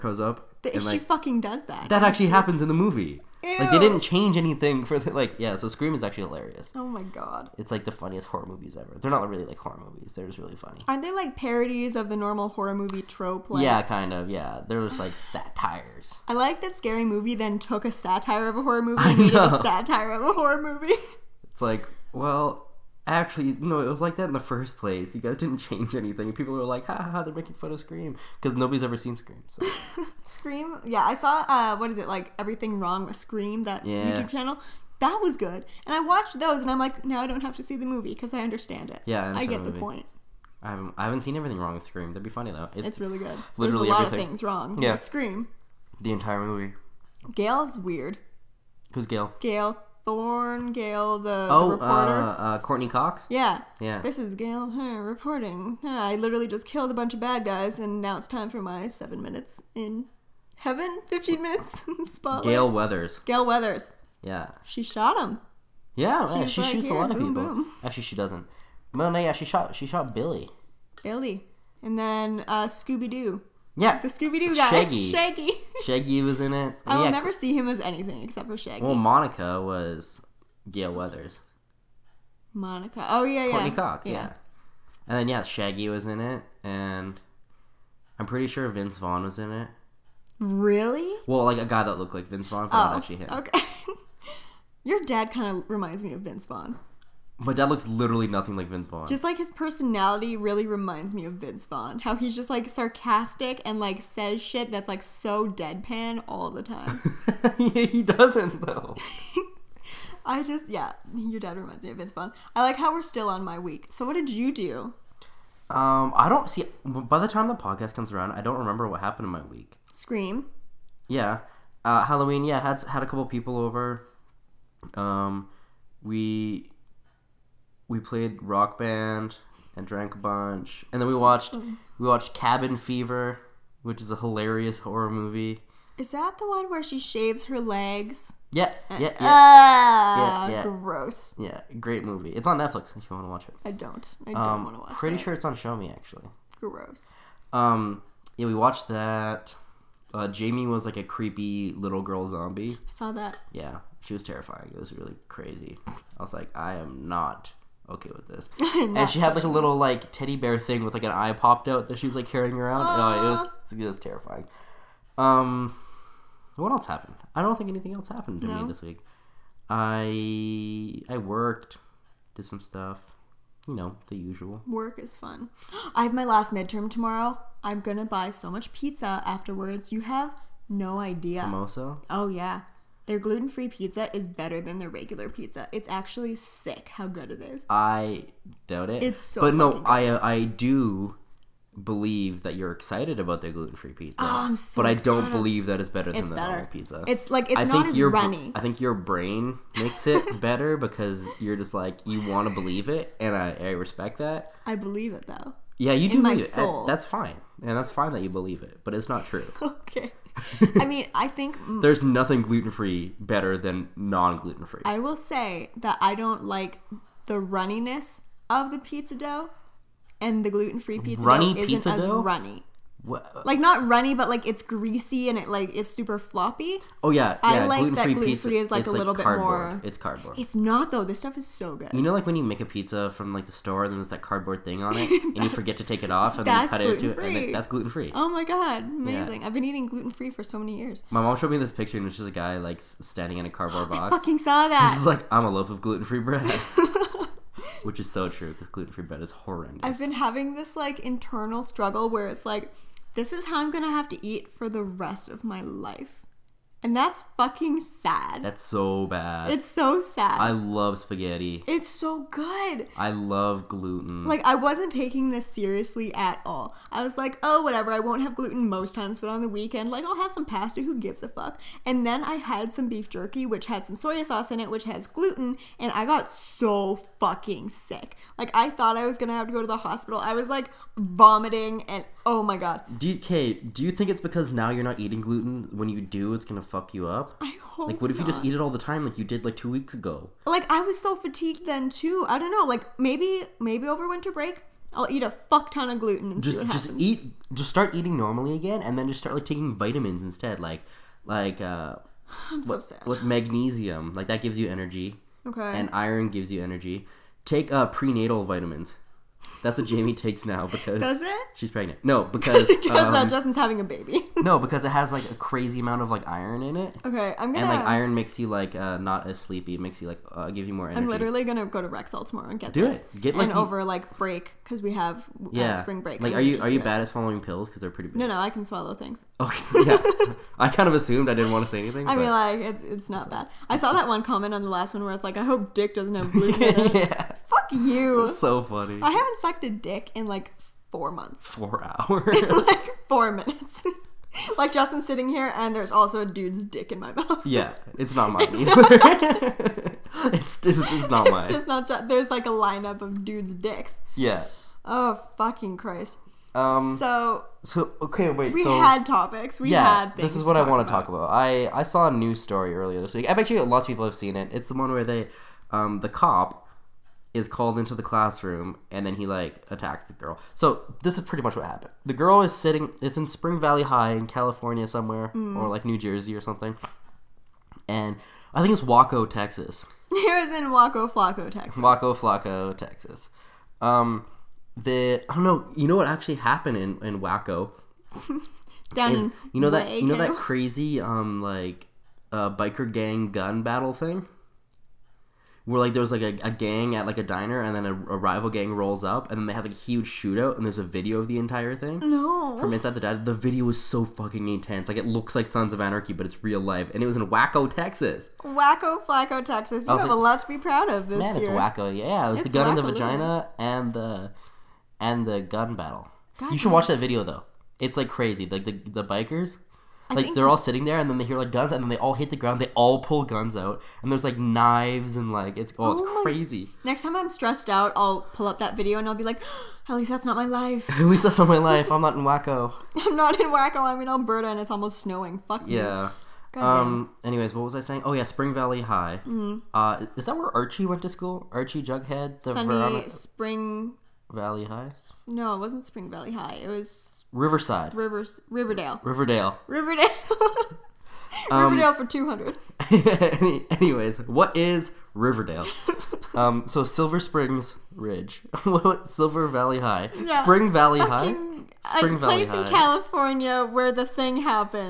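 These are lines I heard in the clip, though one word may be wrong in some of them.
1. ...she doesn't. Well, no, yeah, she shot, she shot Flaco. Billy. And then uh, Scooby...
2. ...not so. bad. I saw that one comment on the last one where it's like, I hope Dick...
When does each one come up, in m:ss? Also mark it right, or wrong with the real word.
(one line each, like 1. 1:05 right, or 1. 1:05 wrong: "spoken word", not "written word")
1. 1:08 wrong: "Billy", not "Flaco"
2. 5:33 right.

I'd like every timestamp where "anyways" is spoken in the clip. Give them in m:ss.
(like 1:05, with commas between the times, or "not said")
7:17, 7:33.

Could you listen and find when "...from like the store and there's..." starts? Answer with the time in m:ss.
3:53.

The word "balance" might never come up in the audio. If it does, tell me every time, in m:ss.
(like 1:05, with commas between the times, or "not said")
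not said.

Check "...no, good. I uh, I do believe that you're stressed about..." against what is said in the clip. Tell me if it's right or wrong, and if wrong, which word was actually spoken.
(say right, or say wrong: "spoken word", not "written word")
wrong: "excited", not "stressed".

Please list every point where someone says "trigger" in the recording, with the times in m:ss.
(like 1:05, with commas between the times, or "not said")
not said.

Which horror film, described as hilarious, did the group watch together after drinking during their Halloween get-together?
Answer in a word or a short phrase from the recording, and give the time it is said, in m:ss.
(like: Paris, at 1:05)
Cabin Fever, at 2:12.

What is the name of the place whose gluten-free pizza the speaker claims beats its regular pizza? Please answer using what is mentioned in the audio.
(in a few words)
Mimosa.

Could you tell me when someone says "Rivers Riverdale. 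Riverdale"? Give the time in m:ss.
7:27.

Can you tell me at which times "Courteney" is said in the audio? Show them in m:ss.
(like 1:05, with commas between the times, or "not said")
0:52, 1:23.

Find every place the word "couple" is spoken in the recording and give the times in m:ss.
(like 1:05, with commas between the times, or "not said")
2:03.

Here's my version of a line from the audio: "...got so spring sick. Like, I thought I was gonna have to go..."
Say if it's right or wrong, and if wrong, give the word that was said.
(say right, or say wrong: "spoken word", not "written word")
wrong: "fucking", not "spring".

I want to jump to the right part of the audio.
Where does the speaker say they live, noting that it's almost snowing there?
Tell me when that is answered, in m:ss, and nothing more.
7:14.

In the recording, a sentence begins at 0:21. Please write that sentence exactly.
It's like well, Actually, no, it was like that in the first place.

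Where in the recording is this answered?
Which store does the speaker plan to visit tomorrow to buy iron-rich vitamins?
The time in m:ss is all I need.
5:21.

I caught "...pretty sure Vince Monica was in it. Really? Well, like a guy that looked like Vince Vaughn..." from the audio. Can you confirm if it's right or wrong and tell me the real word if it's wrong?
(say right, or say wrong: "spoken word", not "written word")
wrong: "Vaughn", not "Monica".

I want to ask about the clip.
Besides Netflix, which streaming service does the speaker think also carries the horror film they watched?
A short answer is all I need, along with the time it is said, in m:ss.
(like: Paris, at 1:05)
Shomi, at 2:25.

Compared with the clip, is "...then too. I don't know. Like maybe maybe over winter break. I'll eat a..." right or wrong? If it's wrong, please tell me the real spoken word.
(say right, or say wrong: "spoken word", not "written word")
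right.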